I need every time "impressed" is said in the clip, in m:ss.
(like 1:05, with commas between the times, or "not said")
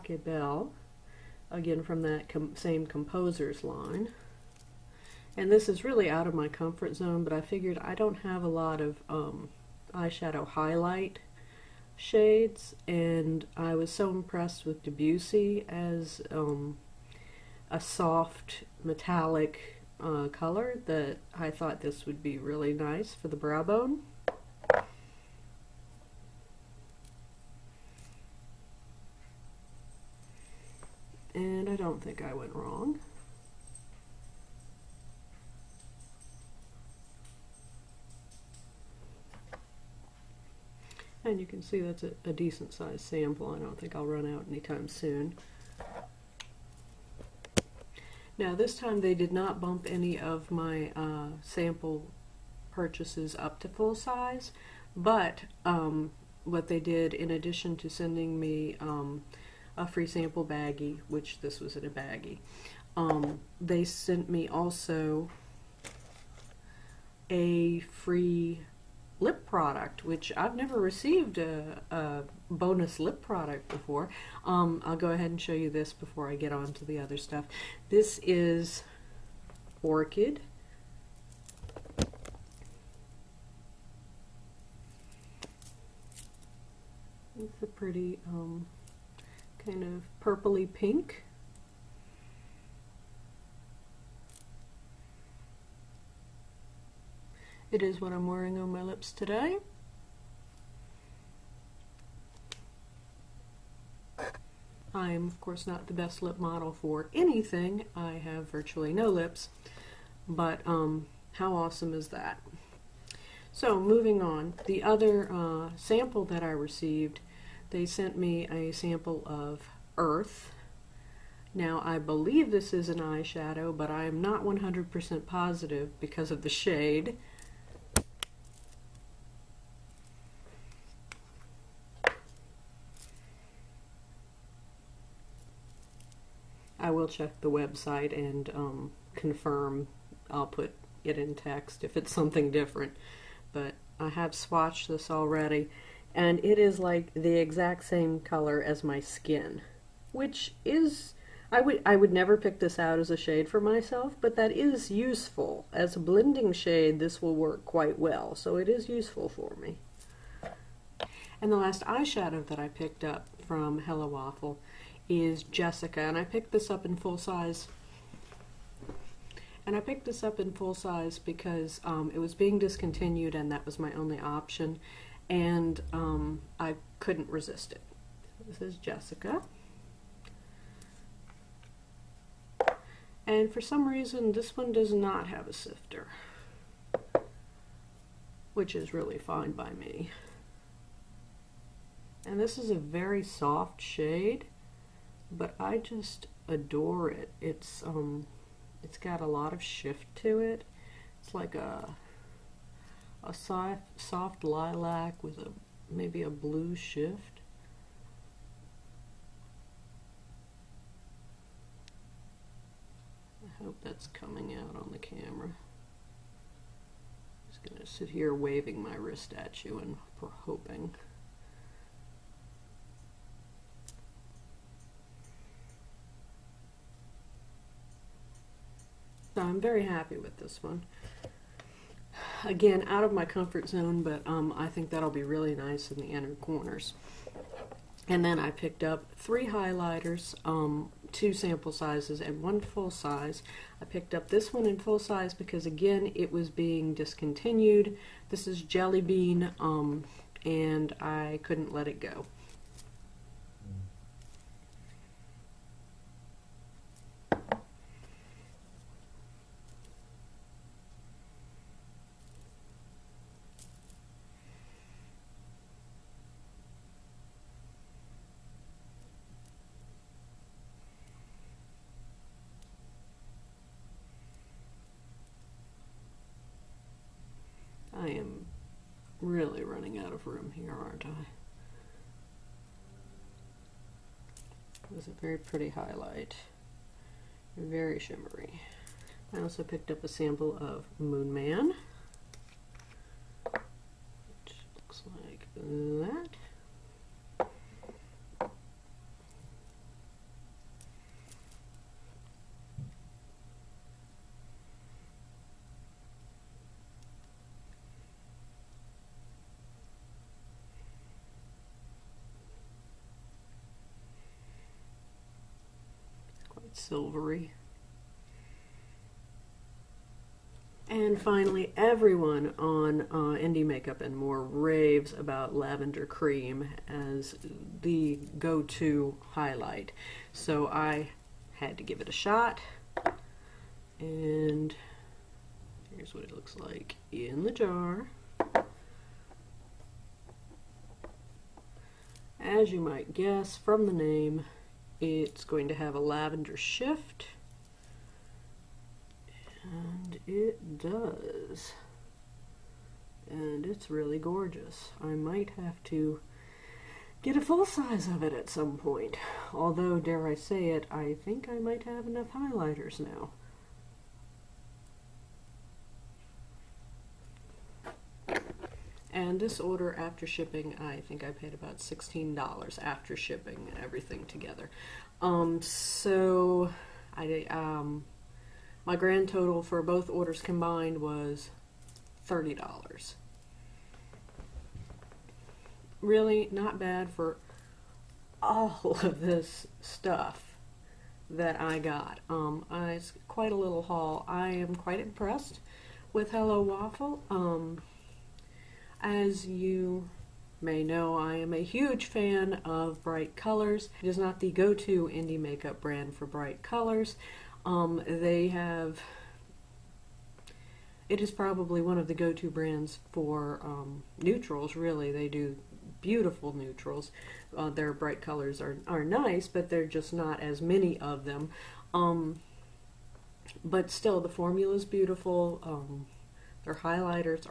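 0:14, 6:34.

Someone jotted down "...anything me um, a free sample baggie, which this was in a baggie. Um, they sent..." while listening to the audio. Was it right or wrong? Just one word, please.
wrong.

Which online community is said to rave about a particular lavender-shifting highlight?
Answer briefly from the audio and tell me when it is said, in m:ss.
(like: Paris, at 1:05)
Indie Makeup and More, at 5:23.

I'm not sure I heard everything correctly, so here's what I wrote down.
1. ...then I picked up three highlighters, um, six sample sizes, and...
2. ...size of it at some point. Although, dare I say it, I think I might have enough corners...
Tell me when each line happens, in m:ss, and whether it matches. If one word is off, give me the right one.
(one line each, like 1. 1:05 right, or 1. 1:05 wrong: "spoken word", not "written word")
1. 3:58 wrong: "two", not "six"
2. 5:57 wrong: "highlighters", not "corners".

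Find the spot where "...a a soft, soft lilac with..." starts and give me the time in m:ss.
3:21.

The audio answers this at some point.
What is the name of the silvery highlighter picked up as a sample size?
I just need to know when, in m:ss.
4:50.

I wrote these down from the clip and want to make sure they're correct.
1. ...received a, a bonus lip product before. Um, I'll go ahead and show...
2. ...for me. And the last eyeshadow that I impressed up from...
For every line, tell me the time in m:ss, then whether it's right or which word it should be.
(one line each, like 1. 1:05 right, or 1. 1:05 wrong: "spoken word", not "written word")
1. 1:10 right
2. 2:39 wrong: "picked", not "impressed".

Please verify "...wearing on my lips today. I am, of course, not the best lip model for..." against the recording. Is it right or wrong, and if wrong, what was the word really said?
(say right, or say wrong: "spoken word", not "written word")
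right.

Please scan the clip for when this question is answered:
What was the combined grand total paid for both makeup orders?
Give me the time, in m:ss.
6:22.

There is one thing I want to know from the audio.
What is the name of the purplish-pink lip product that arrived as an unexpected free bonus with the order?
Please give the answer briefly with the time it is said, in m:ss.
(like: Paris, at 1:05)
Orchid, at 1:19.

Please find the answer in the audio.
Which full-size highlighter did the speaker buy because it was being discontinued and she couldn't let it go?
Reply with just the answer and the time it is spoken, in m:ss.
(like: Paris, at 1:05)
Jelly Bean, at 4:08.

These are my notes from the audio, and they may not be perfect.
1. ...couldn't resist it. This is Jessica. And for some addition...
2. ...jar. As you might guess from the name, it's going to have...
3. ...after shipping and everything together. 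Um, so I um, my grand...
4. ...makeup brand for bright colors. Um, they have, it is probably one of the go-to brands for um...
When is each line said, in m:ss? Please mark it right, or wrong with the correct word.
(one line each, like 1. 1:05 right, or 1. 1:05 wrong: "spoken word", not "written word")
1. 2:56 wrong: "reason", not "addition"
2. 5:37 right
3. 6:12 right
4. 6:45 right.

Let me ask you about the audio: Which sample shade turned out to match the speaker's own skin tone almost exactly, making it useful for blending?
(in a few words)
Earth.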